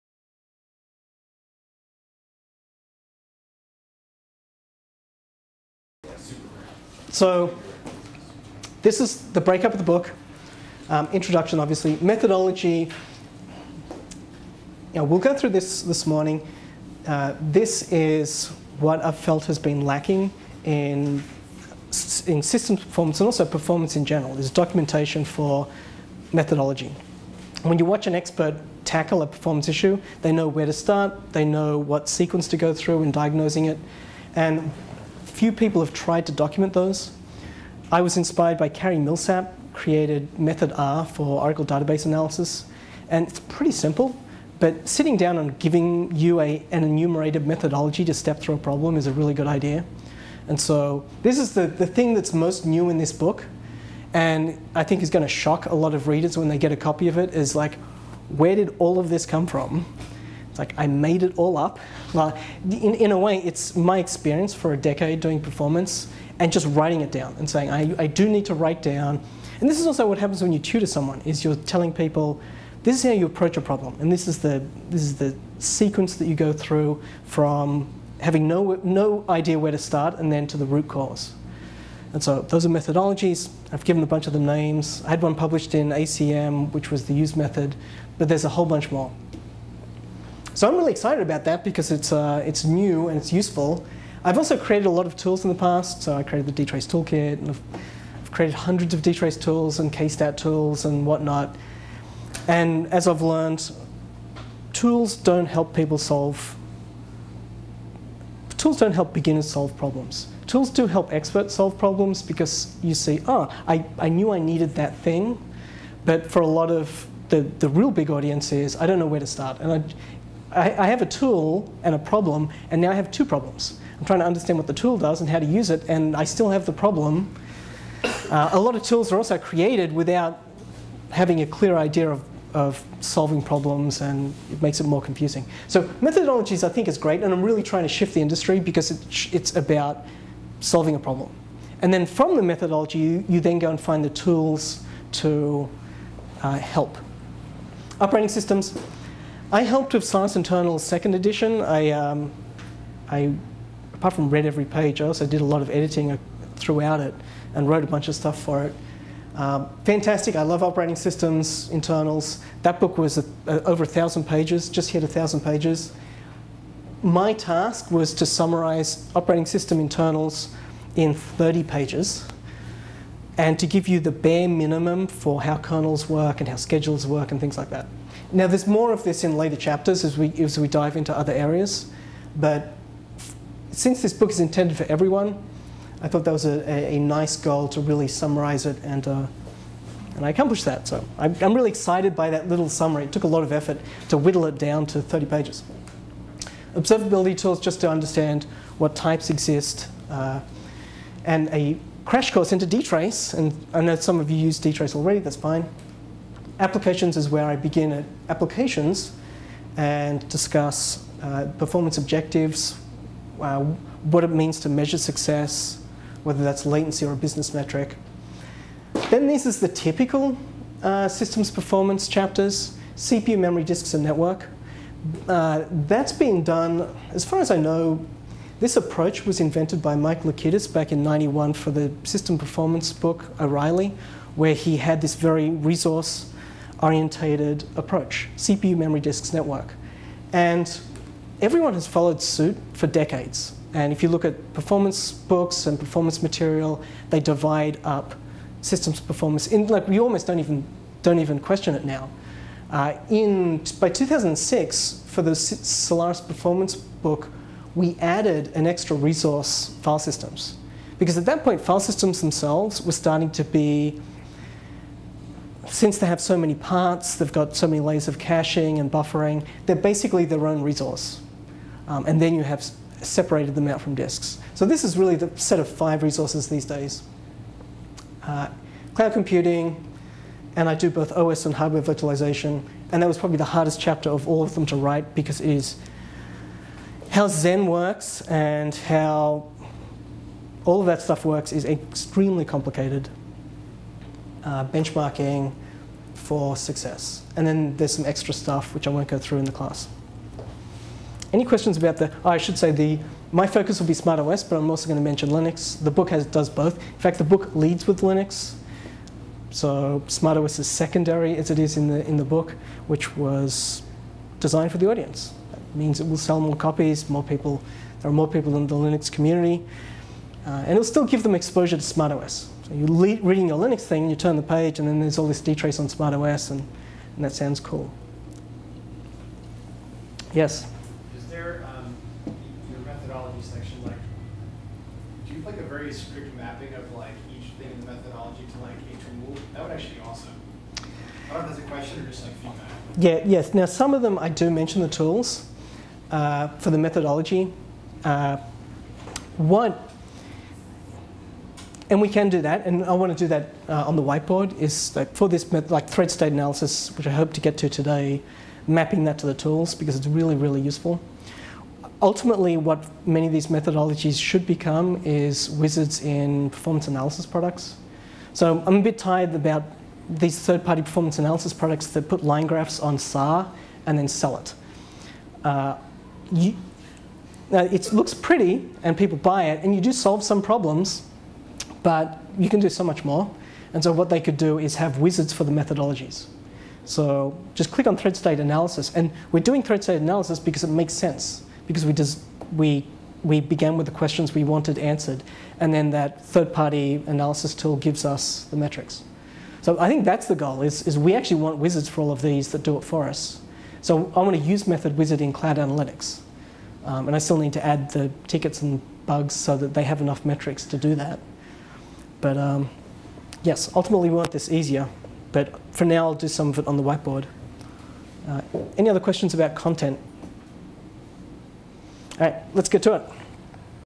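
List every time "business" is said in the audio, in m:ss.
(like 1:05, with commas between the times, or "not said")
3:37.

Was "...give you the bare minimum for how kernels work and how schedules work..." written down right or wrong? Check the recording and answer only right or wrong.
right.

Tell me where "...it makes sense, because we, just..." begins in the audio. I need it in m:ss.
6:30.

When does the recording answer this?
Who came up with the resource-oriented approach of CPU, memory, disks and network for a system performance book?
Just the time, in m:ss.
3:49.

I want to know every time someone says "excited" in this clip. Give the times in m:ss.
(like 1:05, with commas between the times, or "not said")
1:30, 3:11.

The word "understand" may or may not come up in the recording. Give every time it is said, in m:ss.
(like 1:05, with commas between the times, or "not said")
2:04, 3:17.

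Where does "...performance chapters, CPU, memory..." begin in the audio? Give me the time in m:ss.
3:41.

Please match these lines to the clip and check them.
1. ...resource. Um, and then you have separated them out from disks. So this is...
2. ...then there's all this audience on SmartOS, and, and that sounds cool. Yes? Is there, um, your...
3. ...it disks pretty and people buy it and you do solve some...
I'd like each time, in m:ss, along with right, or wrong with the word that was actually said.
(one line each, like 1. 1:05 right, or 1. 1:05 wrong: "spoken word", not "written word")
1. 4:30 right
2. 5:24 wrong: "dtrace", not "audience"
3. 6:17 wrong: "looks", not "disks".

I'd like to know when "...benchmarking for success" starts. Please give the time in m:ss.
4:54.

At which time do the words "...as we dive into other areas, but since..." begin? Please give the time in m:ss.
3:00.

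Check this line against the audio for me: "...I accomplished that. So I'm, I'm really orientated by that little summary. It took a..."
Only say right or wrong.
wrong.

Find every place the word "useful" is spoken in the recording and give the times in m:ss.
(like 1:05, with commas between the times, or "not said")
1:33, 6:00.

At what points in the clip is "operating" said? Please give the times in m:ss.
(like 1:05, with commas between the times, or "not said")
2:27, 2:40, 2:49.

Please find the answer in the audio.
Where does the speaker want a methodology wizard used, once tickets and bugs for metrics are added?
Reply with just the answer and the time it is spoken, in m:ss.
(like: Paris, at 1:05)
Cloud Analytics, at 6:45.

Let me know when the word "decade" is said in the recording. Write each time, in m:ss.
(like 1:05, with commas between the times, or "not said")
1:04, 4:02.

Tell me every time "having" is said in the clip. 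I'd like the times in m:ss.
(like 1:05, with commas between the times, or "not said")
1:18, 2:11.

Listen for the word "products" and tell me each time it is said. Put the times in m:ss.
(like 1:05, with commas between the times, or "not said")
6:07, 6:11.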